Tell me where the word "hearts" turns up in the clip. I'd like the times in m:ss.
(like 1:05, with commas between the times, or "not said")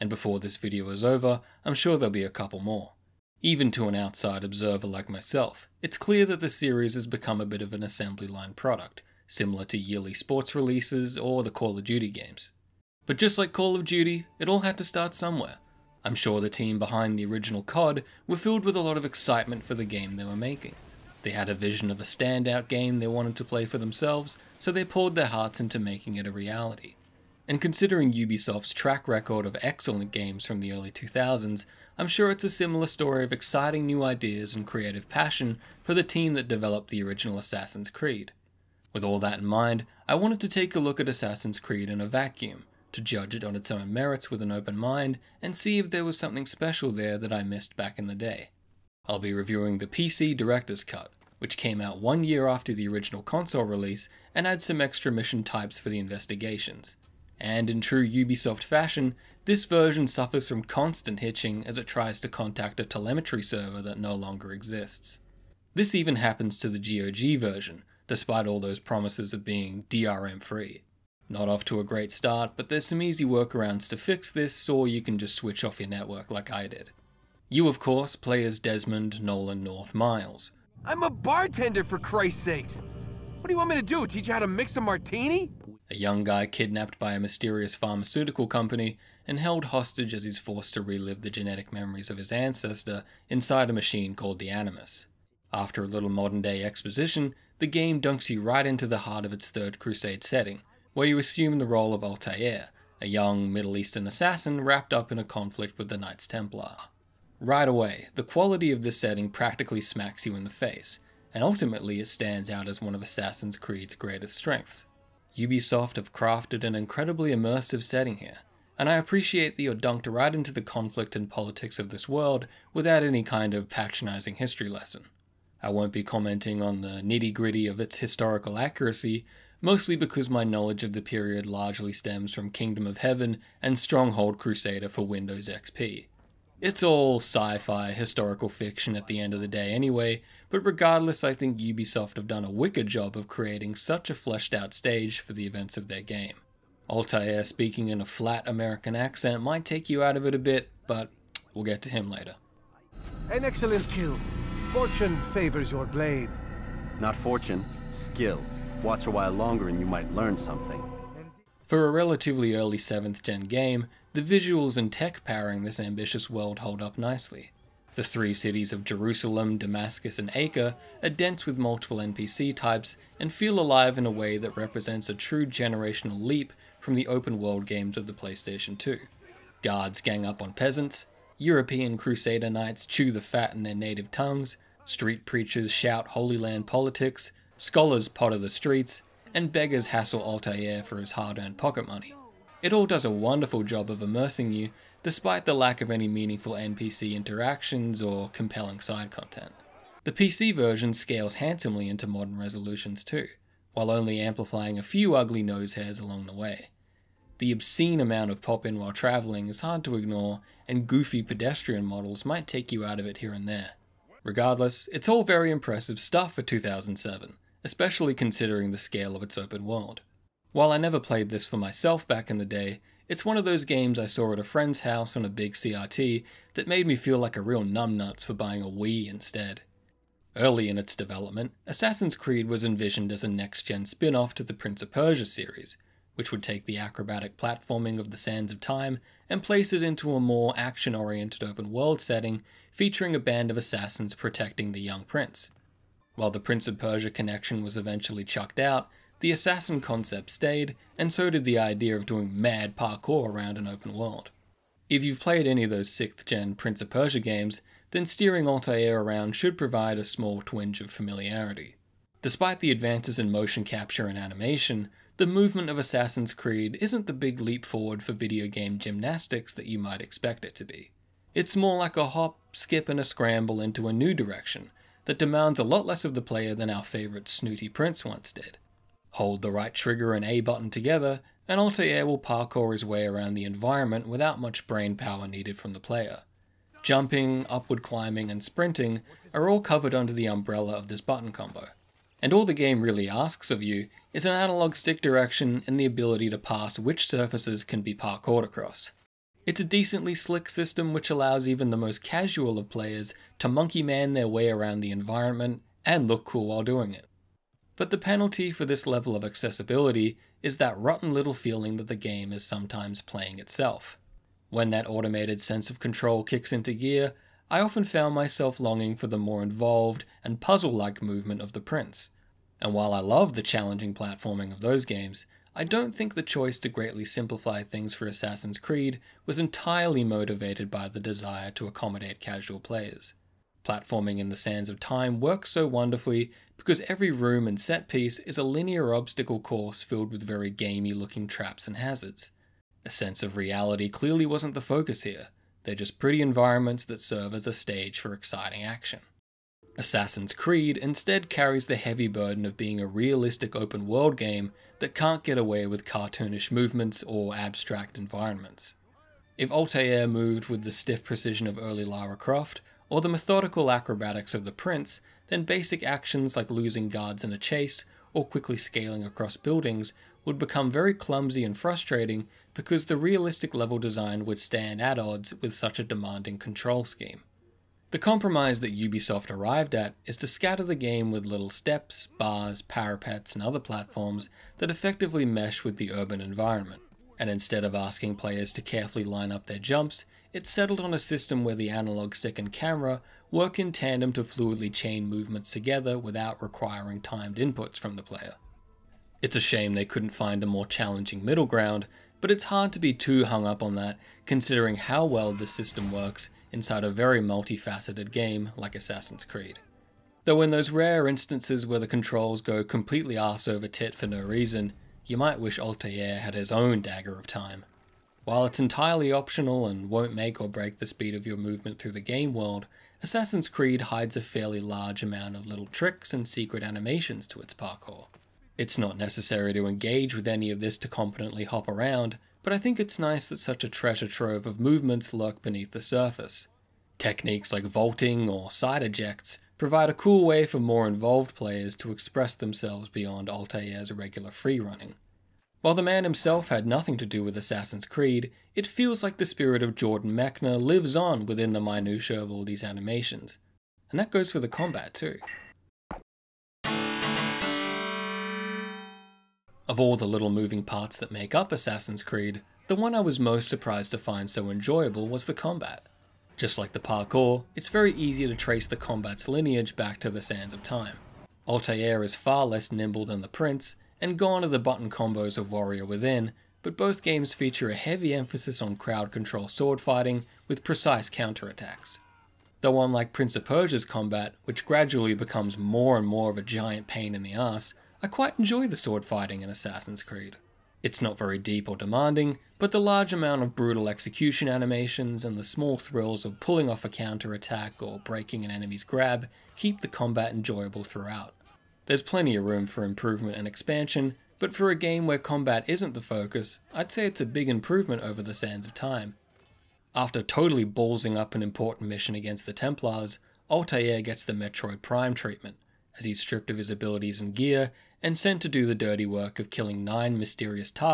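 0:25, 1:38.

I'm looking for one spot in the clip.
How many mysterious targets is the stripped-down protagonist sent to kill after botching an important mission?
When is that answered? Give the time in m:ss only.
8:39.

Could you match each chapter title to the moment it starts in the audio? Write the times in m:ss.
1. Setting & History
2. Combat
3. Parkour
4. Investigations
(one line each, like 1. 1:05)
1. 1:16
2. 7:24
3. 3:49
4. 8:29.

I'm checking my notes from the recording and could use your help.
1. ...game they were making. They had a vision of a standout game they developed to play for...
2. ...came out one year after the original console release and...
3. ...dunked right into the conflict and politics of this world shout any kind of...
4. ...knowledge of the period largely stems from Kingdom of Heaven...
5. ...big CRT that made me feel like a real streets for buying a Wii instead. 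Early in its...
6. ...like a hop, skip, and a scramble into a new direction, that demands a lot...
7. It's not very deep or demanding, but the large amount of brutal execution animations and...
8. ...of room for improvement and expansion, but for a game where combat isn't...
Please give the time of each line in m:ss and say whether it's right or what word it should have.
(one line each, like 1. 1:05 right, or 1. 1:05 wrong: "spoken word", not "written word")
1. 0:19 wrong: "wanted", not "developed"
2. 0:51 right
3. 1:59 wrong: "without", not "shout"
4. 2:10 right
5. 3:45 wrong: "numbnuts", not "streets"
6. 4:31 right
7. 8:10 right
8. 8:22 right.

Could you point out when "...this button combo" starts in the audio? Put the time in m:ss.
4:50.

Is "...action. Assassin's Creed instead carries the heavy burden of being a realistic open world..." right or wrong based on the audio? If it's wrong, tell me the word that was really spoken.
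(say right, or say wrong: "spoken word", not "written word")
right.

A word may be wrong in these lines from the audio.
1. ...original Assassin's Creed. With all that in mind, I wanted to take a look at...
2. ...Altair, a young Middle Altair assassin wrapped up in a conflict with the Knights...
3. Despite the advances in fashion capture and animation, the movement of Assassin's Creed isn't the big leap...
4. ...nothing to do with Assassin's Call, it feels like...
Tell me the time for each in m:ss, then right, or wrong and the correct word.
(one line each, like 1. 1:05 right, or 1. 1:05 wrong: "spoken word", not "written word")
1. 0:37 right
2. 1:42 wrong: "Eastern", not "Altair"
3. 4:22 wrong: "motion", not "fashion"
4. 7:26 wrong: "Creed", not "Call".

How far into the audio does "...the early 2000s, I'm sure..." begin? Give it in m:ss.
0:30.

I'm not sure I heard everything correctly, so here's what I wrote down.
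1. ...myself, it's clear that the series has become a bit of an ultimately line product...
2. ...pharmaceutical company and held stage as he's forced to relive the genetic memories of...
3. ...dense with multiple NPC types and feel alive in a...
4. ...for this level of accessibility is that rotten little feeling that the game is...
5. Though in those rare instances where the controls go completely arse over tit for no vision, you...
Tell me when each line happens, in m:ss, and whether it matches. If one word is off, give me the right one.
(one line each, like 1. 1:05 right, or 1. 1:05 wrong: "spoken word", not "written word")
1. 0:05 wrong: "assembly", not "ultimately"
2. 1:27 wrong: "hostage", not "stage"
3. 2:51 right
4. 5:08 right
5. 6:50 wrong: "reason", not "vision".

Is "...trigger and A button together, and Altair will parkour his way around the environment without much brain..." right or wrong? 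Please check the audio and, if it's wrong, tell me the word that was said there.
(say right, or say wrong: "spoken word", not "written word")
right.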